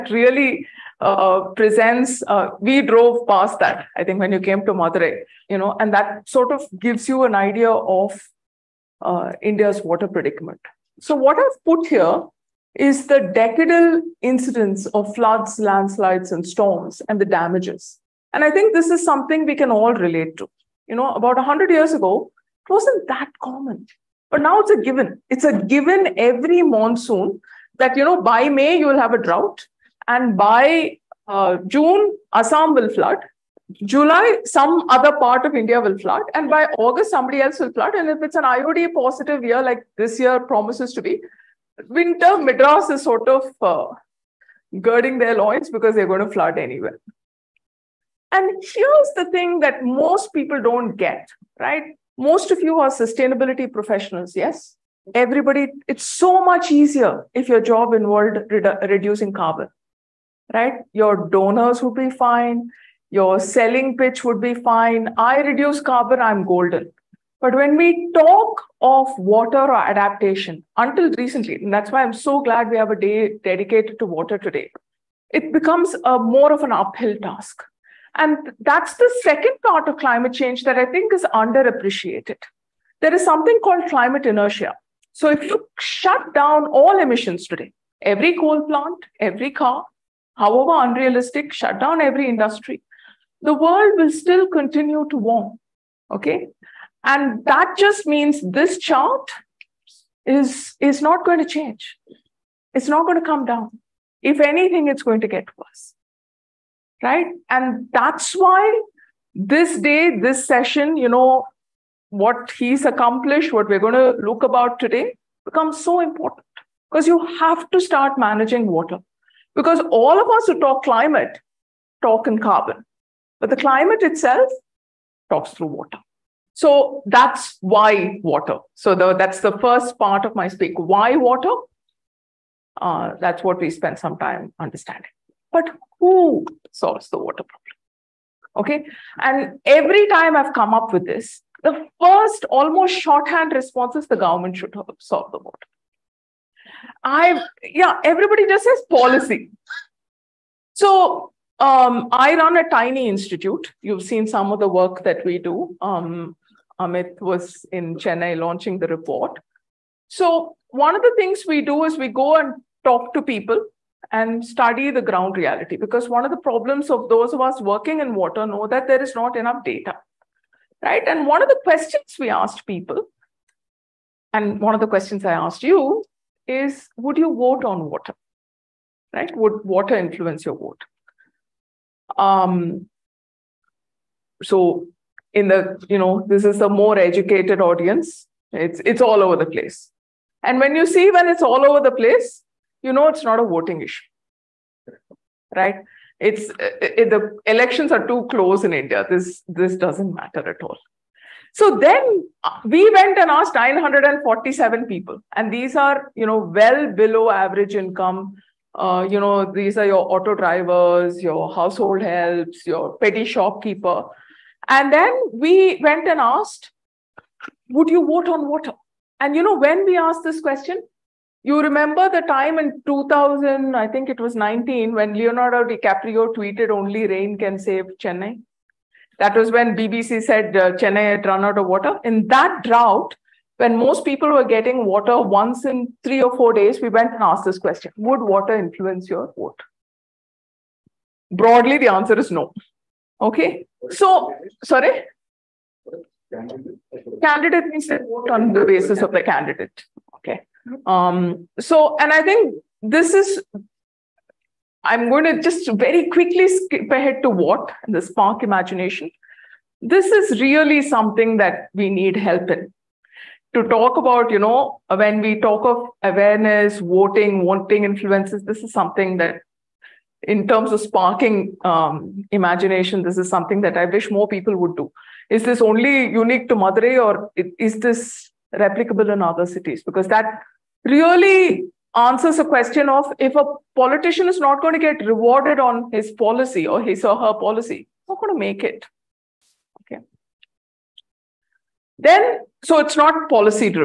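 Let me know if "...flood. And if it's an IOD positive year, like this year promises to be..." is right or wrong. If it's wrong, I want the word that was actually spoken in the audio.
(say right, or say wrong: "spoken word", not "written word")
right.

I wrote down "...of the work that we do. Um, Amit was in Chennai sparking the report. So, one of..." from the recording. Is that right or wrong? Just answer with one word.
wrong.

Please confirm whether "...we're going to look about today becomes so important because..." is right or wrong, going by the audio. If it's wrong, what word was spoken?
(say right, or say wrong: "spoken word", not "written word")
right.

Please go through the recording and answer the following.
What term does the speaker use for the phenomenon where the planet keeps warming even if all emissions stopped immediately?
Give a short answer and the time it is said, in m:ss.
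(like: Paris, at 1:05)
climate inertia, at 1:23.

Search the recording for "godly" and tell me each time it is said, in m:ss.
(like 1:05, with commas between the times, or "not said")
not said.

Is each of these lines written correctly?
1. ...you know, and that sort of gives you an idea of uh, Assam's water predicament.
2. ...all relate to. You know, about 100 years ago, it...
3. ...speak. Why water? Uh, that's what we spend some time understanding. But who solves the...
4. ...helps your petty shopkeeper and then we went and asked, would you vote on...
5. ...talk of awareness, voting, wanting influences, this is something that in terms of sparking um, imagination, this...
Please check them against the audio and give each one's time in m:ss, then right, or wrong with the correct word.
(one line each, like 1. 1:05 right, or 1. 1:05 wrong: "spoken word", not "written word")
1. 0:05 wrong: "India", not "Assam"
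2. 0:19 right
3. 2:10 right
4. 3:32 right
5. 4:25 right.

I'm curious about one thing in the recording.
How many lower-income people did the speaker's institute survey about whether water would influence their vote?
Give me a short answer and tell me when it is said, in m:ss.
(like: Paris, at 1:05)
947, at 3:23.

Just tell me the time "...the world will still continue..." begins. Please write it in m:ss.
1:33.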